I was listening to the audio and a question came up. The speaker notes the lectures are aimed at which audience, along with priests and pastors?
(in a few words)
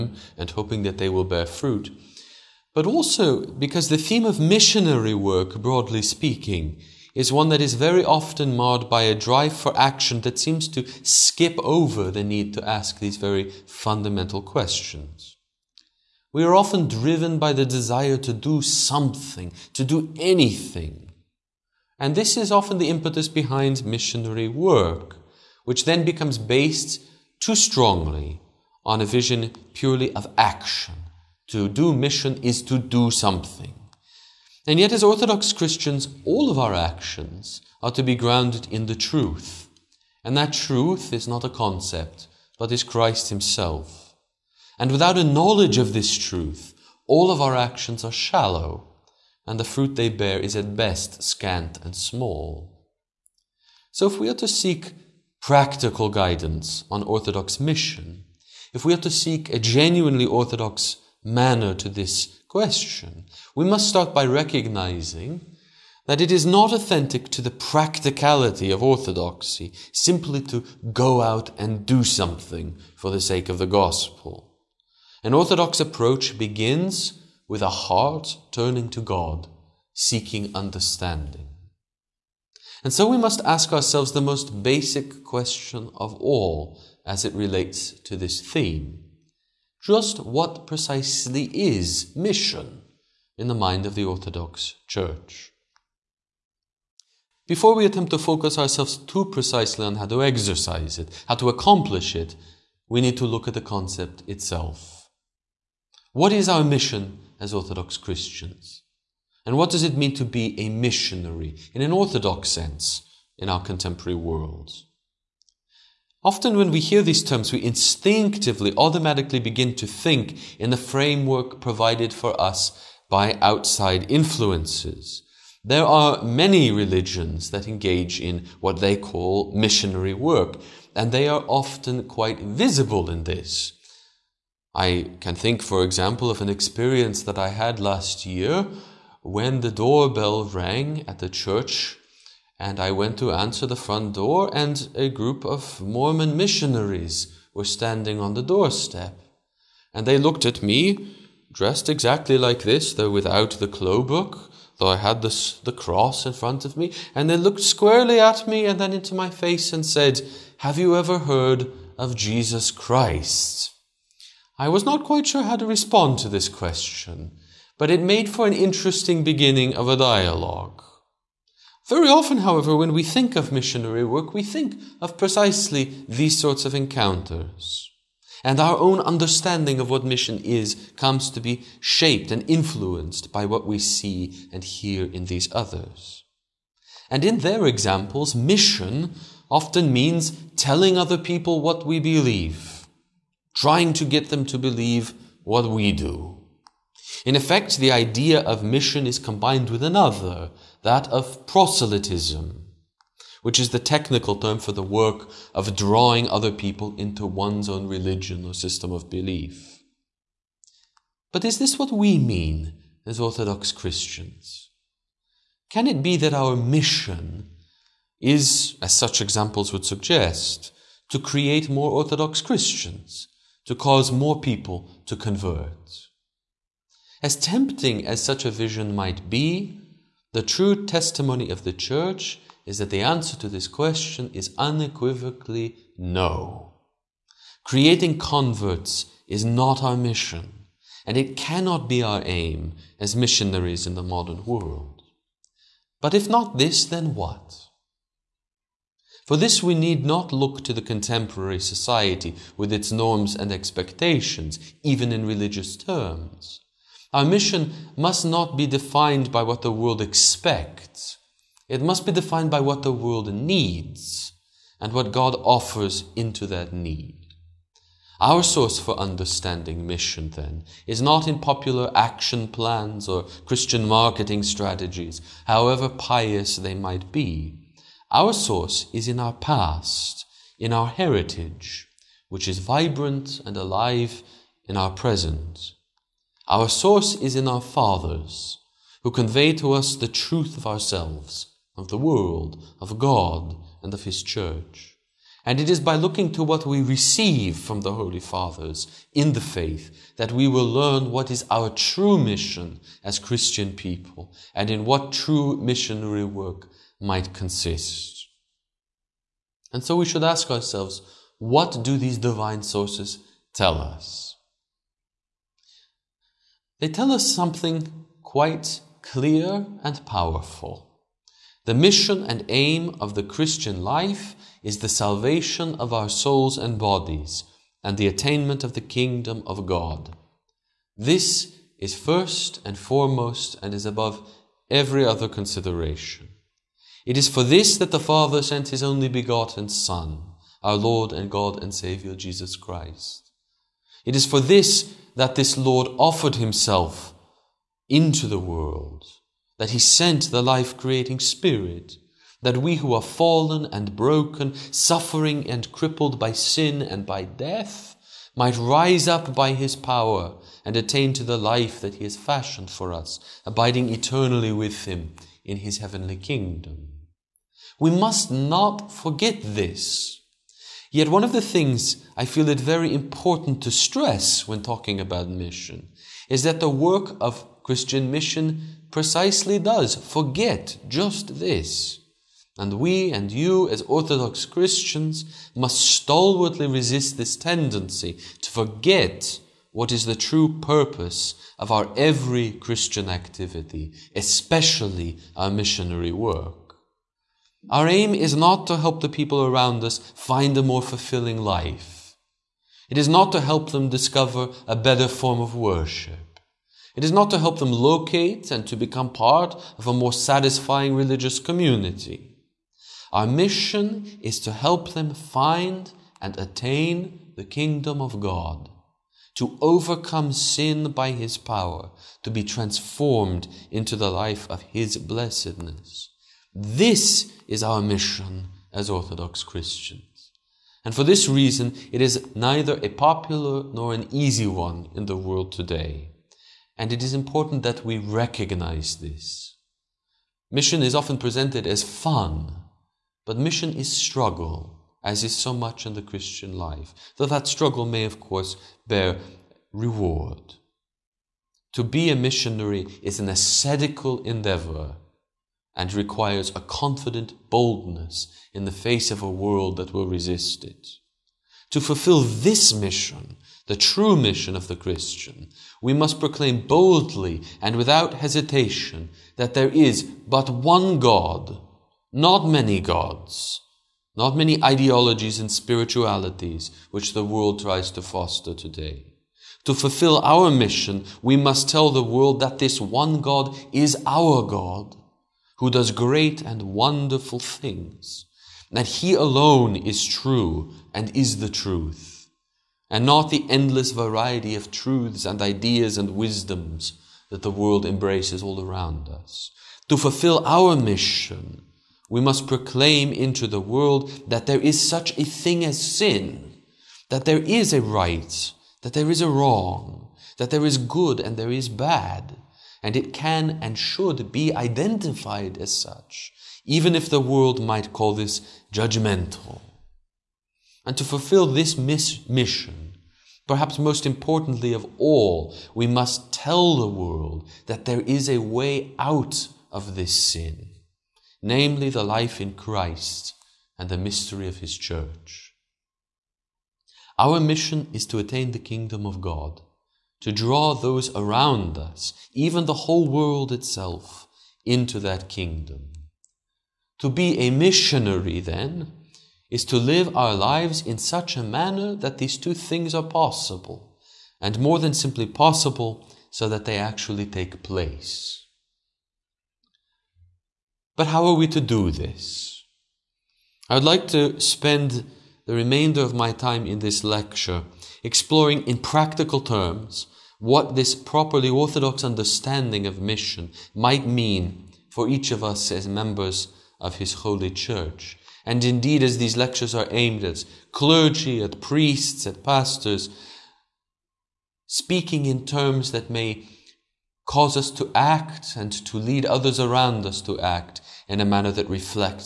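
clergy.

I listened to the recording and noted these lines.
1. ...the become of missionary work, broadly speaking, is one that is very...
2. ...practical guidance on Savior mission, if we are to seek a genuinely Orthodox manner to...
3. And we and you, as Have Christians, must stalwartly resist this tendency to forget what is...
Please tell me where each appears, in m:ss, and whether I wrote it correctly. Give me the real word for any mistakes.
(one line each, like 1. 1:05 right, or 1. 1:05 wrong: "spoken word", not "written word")
1. 0:03 wrong: "theme", not "become"
2. 0:55 wrong: "Orthodox", not "Savior"
3. 6:22 wrong: "Orthodox", not "Have".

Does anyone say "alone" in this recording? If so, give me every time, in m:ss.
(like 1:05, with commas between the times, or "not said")
8:09.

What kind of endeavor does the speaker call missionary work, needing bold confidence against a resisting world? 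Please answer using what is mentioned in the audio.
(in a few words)
ascetical.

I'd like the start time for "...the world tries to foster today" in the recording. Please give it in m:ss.
7:57.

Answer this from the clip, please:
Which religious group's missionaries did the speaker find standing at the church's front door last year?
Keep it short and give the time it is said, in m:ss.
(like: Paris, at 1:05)
Mormon, at 2:25.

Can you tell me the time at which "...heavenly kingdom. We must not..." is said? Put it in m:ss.
6:05.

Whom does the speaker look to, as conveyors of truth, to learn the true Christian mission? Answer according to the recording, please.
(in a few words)
the Holy Fathers.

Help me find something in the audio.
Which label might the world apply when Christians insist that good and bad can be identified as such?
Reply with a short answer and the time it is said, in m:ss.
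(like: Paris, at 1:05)
judgmental, at 8:38.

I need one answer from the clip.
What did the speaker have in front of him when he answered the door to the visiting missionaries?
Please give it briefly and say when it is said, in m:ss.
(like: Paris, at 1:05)
the cross, at 2:35.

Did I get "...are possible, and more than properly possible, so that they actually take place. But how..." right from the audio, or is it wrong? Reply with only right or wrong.
wrong.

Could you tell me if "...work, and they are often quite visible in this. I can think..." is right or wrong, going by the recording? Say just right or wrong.
right.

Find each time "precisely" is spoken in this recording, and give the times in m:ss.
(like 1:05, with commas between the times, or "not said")
1:30, 1:39, 2:55, 6:18.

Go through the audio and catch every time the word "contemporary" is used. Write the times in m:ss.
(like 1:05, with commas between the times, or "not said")
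1:53, 4:10.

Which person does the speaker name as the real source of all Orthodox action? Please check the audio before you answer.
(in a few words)
Christ Himself.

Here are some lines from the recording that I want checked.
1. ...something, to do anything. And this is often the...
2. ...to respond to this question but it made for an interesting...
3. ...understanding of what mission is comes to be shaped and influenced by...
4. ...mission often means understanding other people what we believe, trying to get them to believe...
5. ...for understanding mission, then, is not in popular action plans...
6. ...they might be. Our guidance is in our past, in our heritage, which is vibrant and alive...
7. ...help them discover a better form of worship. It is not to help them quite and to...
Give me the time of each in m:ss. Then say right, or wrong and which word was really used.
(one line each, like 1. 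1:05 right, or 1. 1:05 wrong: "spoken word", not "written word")
1. 0:18 right
2. 2:45 right
3. 2:59 right
4. 3:08 wrong: "telling", not "understanding"
5. 4:28 right
6. 4:36 wrong: "source", not "guidance"
7. 6:43 wrong: "locate", not "quite".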